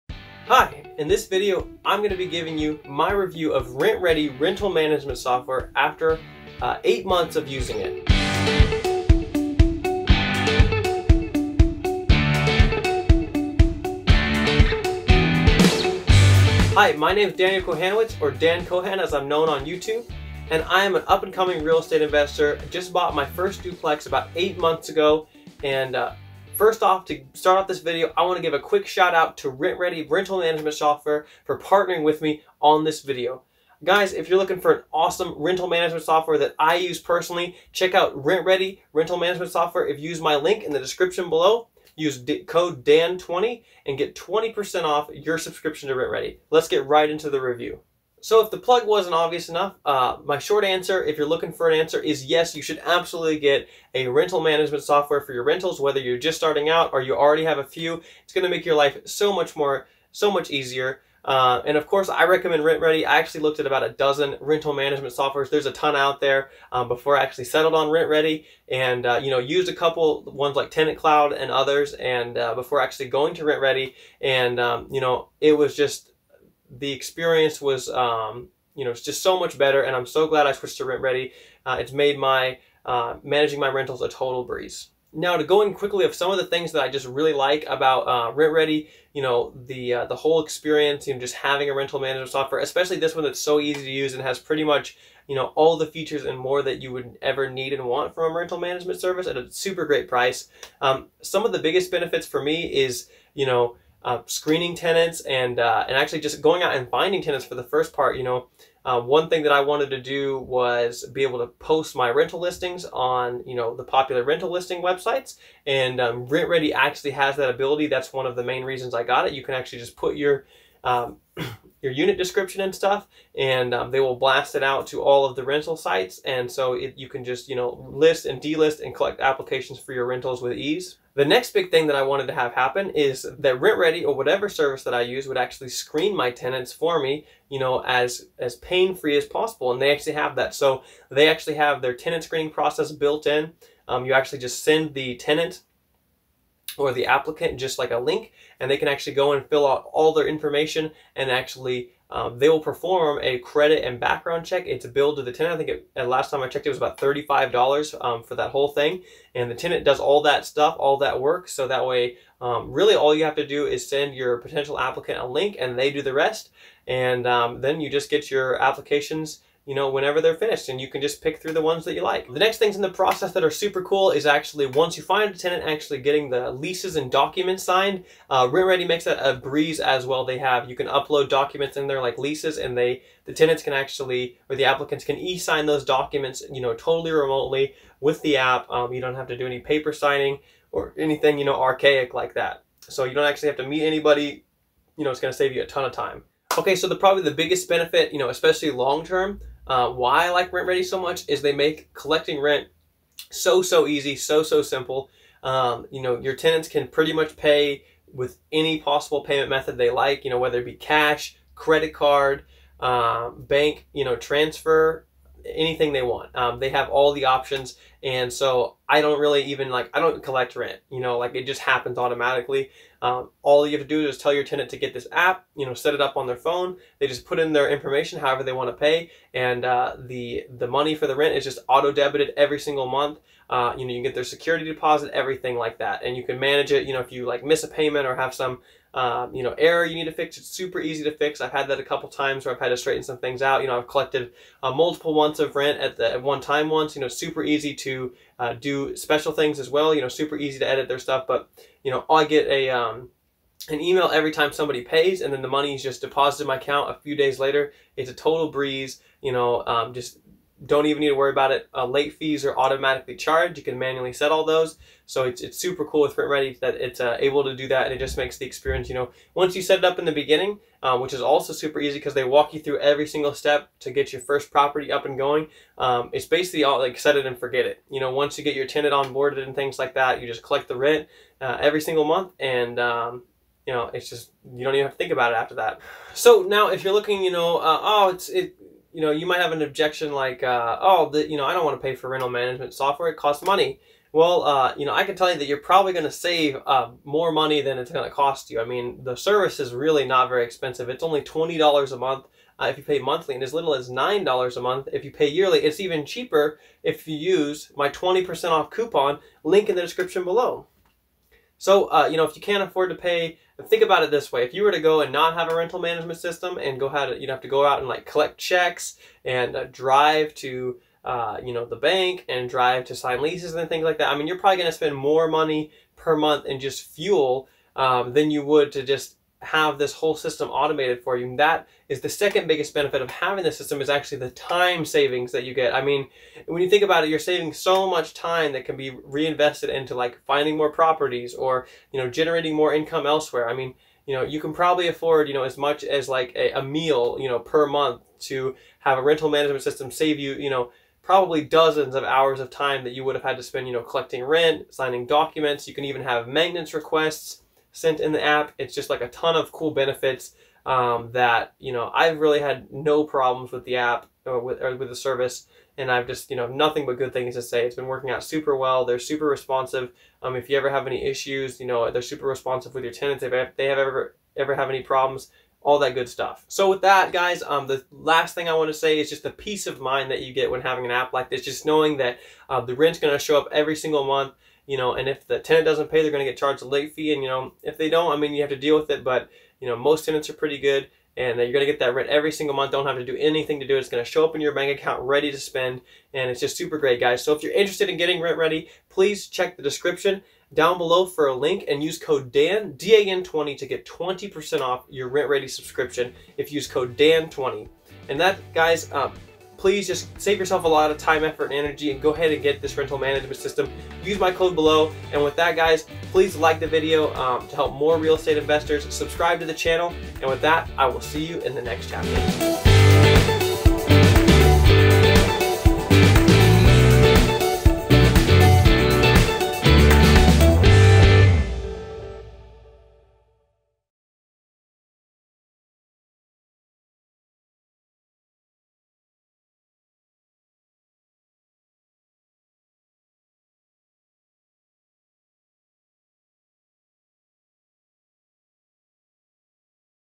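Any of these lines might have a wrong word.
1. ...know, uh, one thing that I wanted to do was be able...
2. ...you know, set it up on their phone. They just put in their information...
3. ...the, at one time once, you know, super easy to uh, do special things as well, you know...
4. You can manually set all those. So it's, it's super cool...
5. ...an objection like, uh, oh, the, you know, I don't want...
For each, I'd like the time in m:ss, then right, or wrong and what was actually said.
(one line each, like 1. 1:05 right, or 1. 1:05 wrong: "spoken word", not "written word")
1. 1:48 right
2. 3:45 right
3. 4:05 right
4. 4:23 right
5. 4:49 right.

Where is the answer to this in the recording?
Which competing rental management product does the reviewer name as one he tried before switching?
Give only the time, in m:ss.
1:10.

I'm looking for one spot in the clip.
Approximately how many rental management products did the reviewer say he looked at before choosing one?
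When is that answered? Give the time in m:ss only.
1:03.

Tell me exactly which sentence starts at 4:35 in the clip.
Um, it's basically all like set it and forget it.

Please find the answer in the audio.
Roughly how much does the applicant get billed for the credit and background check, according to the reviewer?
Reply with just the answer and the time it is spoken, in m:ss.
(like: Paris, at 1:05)
$35, at 2:36.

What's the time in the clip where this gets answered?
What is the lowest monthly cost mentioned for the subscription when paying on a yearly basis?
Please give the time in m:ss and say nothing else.
5:03.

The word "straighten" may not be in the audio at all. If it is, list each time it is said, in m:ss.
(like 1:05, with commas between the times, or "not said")
4:02.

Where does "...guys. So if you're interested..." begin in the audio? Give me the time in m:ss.
6:36.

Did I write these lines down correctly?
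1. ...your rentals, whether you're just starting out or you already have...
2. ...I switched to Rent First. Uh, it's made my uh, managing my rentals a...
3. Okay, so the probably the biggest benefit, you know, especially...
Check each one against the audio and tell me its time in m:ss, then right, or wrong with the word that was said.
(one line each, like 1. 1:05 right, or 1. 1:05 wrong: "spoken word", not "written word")
1. 0:55 right
2. 1:20 wrong: "Redi", not "First"
3. 3:16 right.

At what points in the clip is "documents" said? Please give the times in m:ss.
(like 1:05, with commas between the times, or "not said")
2:57, 3:01, 3:05, 5:55.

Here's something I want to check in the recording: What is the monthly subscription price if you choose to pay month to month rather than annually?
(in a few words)
$20 a month.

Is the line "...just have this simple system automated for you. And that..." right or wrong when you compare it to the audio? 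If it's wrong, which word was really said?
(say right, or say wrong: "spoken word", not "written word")
wrong: "whole", not "simple".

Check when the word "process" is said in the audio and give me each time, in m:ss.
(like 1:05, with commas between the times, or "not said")
2:22, 2:52.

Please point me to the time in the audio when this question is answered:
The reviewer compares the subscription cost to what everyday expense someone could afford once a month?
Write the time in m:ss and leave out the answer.
5:46.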